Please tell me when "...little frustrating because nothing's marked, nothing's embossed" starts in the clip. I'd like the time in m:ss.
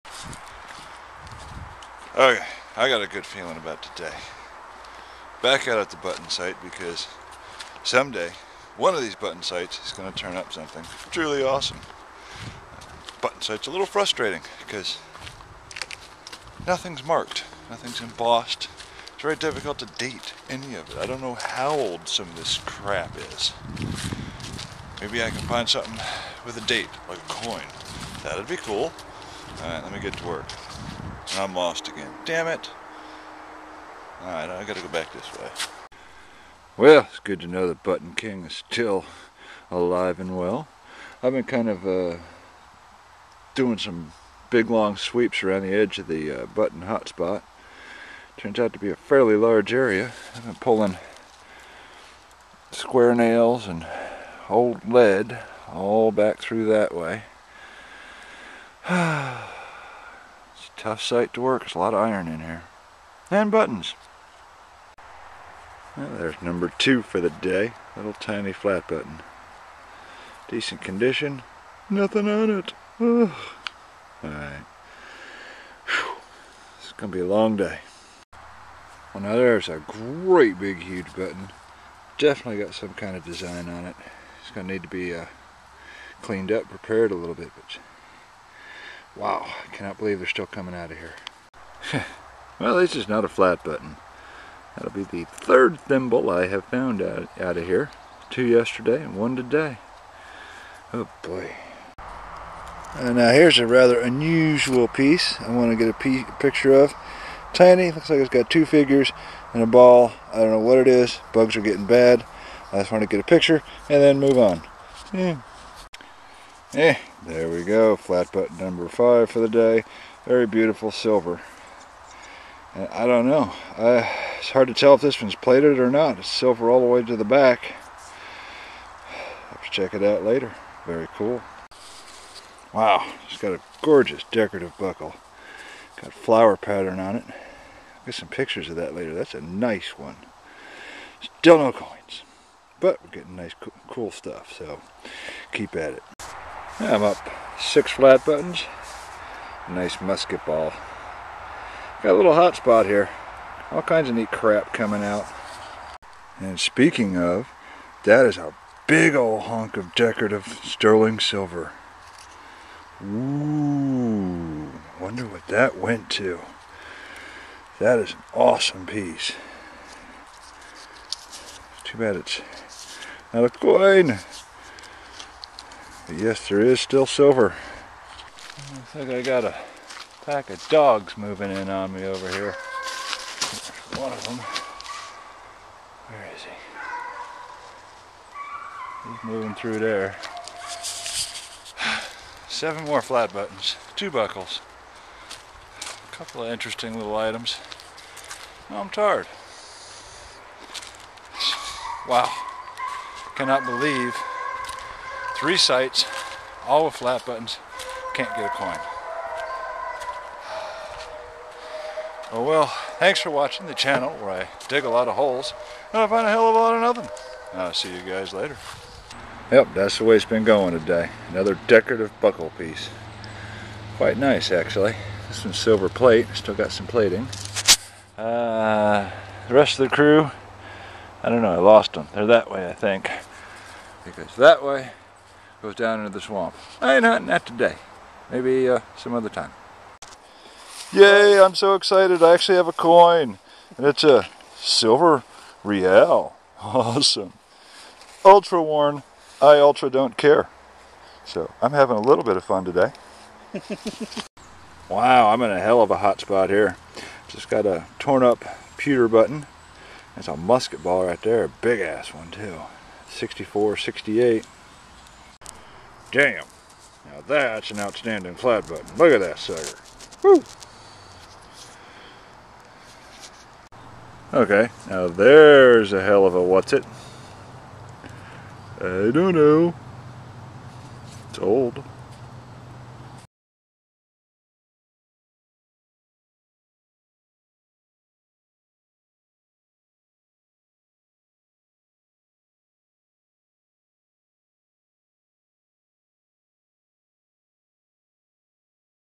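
0:13.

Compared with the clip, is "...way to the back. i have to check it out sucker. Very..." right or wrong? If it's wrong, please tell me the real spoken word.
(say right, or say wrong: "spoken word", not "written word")
wrong: "later", not "sucker".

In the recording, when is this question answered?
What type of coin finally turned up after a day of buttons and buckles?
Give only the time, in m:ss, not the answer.
4:04.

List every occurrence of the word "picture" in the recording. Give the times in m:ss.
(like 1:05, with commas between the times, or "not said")
1:46, 1:53, 2:18.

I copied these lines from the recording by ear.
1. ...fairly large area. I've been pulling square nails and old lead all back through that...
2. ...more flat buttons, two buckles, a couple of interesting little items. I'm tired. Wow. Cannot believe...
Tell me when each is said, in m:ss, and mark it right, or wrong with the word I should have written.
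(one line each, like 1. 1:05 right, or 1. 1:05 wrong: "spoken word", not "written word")
1. 0:48 right
2. 3:12 right.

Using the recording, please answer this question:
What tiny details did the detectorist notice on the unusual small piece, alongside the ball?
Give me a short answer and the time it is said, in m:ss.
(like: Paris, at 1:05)
two figures, at 1:48.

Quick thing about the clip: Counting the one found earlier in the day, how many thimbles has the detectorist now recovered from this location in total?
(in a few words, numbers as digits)
3.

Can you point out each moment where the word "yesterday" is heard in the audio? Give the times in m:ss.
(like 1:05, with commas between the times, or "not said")
1:38.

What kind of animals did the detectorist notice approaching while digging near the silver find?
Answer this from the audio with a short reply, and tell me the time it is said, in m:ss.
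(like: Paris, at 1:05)
a pack of dogs, at 3:00.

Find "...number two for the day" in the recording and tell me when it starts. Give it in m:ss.
1:06.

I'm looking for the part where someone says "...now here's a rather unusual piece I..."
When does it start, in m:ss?
1:43.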